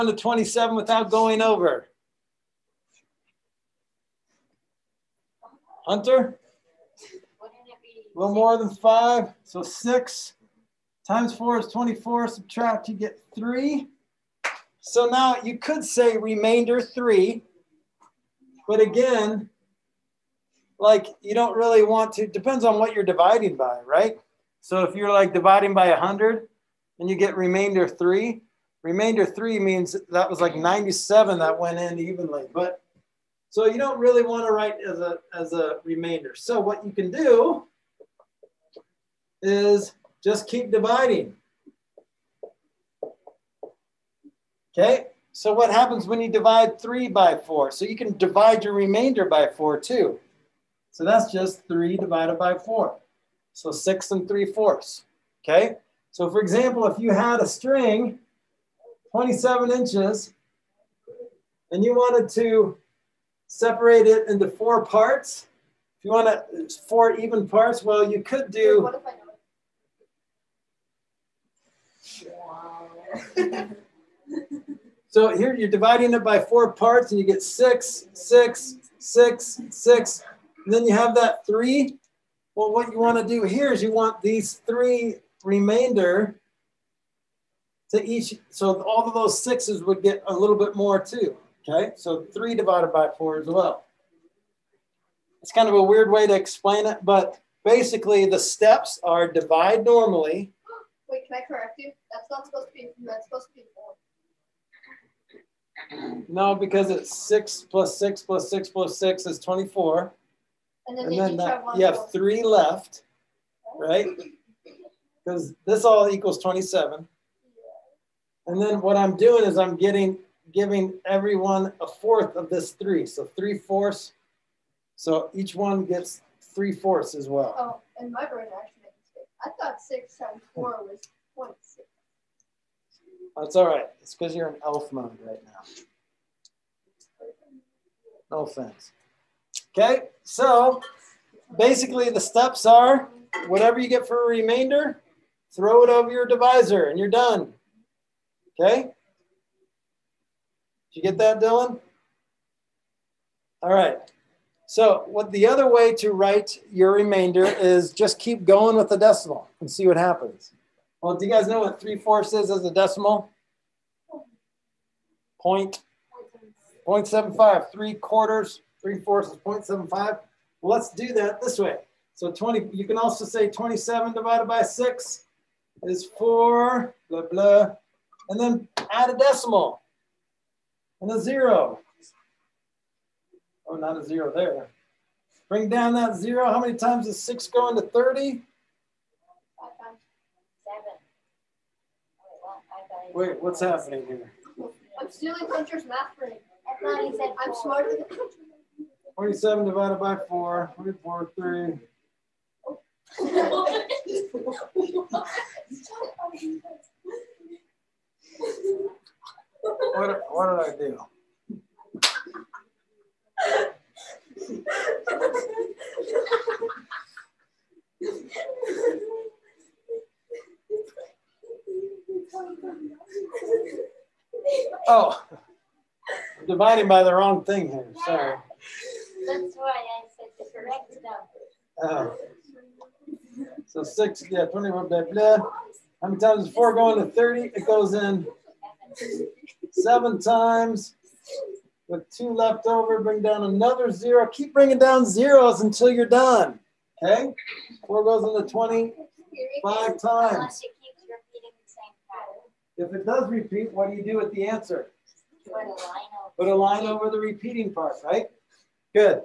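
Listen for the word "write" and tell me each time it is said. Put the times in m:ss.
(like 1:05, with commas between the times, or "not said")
0:34, 2:36.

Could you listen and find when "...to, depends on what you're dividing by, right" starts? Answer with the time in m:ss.
0:22.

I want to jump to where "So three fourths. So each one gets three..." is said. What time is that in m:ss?
2:03.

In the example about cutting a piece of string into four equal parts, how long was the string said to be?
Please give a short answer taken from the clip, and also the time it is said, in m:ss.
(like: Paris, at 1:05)
27 inches, at 0:59.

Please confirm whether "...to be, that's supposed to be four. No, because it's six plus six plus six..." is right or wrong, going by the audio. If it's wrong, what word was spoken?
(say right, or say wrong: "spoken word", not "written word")
right.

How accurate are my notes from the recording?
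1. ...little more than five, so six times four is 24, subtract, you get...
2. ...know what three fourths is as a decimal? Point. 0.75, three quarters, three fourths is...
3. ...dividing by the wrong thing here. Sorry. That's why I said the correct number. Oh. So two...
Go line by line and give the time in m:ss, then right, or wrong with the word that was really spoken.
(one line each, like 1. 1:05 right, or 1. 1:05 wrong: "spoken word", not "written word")
1. 0:08 right
2. 2:41 right
3. 3:46 wrong: "six", not "two".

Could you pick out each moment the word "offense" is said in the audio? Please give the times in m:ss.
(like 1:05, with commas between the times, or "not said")
2:18.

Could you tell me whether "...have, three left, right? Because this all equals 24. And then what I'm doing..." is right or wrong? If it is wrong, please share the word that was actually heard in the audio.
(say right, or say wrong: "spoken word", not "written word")
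wrong: "27", not "24".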